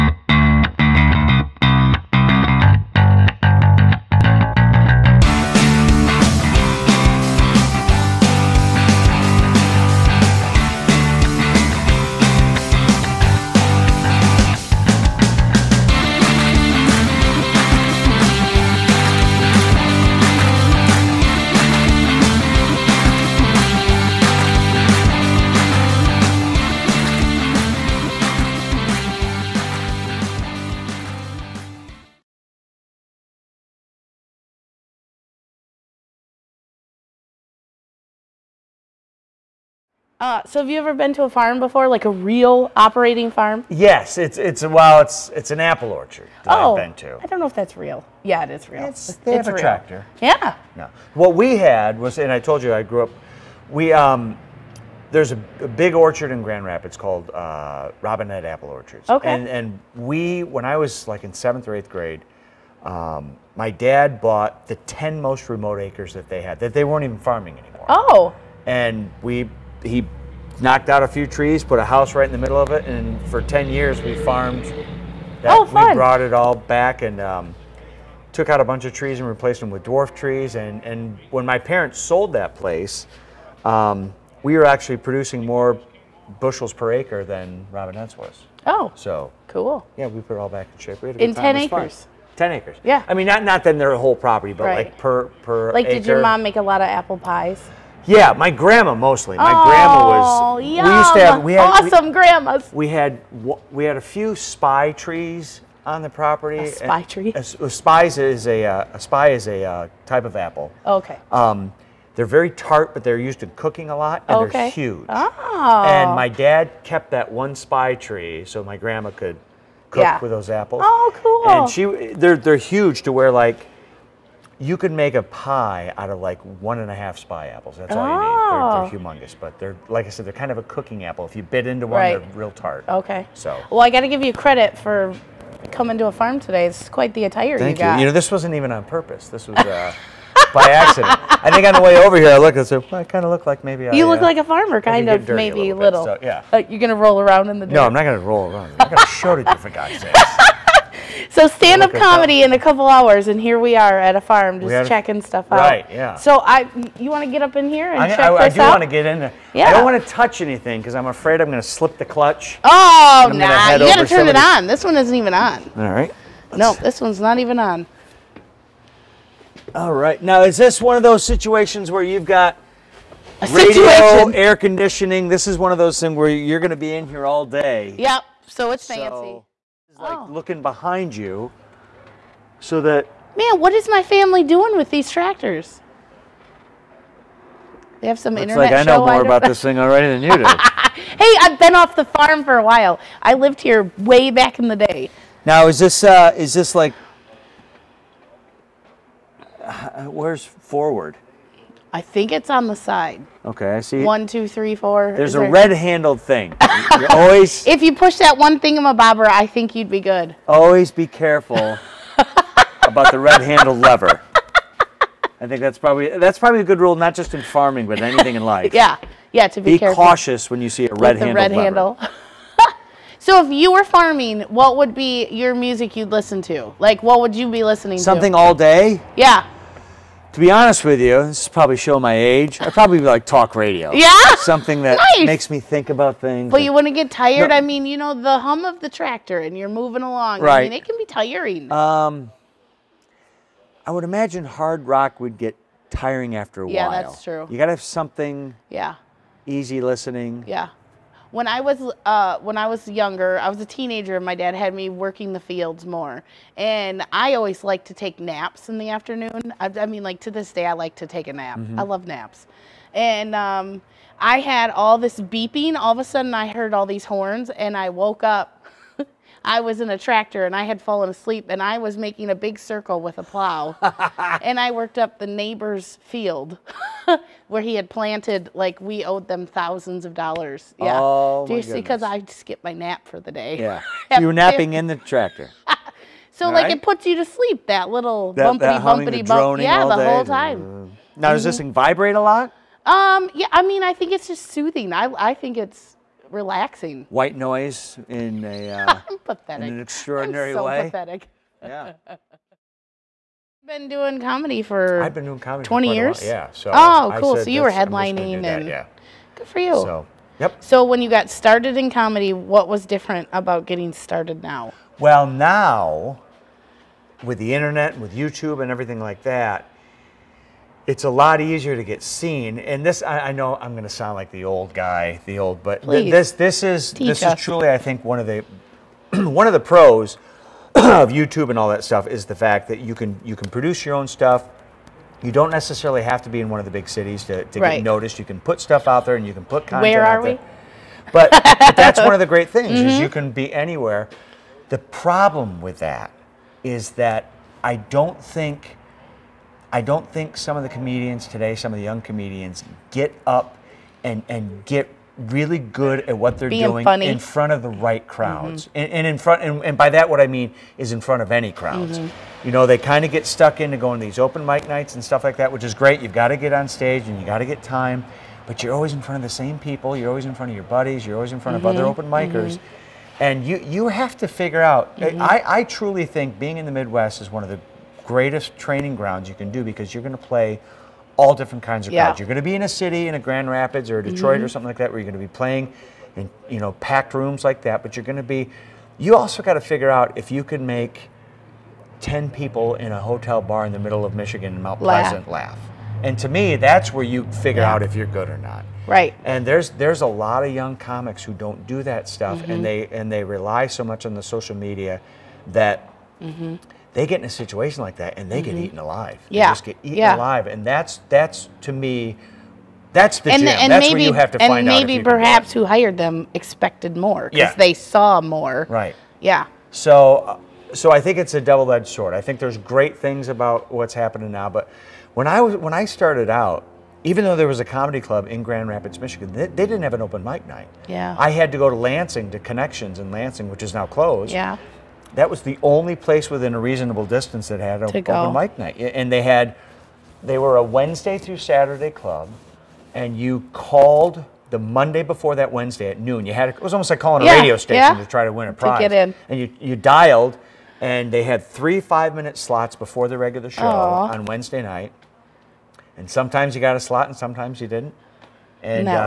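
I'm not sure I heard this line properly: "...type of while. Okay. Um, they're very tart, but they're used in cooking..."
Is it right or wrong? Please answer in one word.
wrong.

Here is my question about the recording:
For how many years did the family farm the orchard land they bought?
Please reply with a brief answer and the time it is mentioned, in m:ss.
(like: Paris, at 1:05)
10 years, at 1:13.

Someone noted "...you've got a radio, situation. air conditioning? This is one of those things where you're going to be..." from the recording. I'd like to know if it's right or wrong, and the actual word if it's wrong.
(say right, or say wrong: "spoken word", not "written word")
right.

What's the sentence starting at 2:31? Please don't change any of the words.
So stand up comedy in a couple hours, and here we are at a farm just checking stuff out.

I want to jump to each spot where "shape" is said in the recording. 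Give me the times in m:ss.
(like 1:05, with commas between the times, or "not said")
1:30.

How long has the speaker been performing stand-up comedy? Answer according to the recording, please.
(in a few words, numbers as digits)
20 years.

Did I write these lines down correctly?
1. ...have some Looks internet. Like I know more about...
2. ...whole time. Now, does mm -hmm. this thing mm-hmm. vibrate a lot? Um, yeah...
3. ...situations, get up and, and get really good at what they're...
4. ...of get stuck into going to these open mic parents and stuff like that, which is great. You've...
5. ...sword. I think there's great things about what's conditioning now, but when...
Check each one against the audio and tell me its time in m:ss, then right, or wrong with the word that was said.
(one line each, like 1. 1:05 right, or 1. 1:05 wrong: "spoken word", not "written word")
1. 3:08 right
2. 4:50 right
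3. 5:52 wrong: "comedians", not "situations"
4. 6:03 wrong: "nights", not "parents"
5. 7:01 wrong: "happening", not "conditioning".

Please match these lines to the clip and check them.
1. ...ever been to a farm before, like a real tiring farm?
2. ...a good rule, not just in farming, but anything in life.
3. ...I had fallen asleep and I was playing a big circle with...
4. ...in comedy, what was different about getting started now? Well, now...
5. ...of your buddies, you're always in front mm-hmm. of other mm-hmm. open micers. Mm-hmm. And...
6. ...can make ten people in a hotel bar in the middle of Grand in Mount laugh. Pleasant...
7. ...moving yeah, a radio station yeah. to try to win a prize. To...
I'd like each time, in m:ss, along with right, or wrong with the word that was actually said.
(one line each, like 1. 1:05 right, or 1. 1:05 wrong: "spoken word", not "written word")
1. 0:40 wrong: "operating", not "tiring"
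2. 3:36 right
3. 4:30 wrong: "making", not "playing"
4. 5:11 right
5. 6:10 right
6. 6:30 wrong: "Michigan", not "Grand"
7. 7:26 wrong: "calling", not "moving".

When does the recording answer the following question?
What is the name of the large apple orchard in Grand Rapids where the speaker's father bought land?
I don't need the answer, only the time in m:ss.
0:58.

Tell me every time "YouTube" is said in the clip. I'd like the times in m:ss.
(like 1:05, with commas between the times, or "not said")
5:18, 5:31.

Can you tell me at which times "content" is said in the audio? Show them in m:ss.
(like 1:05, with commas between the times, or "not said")
5:39.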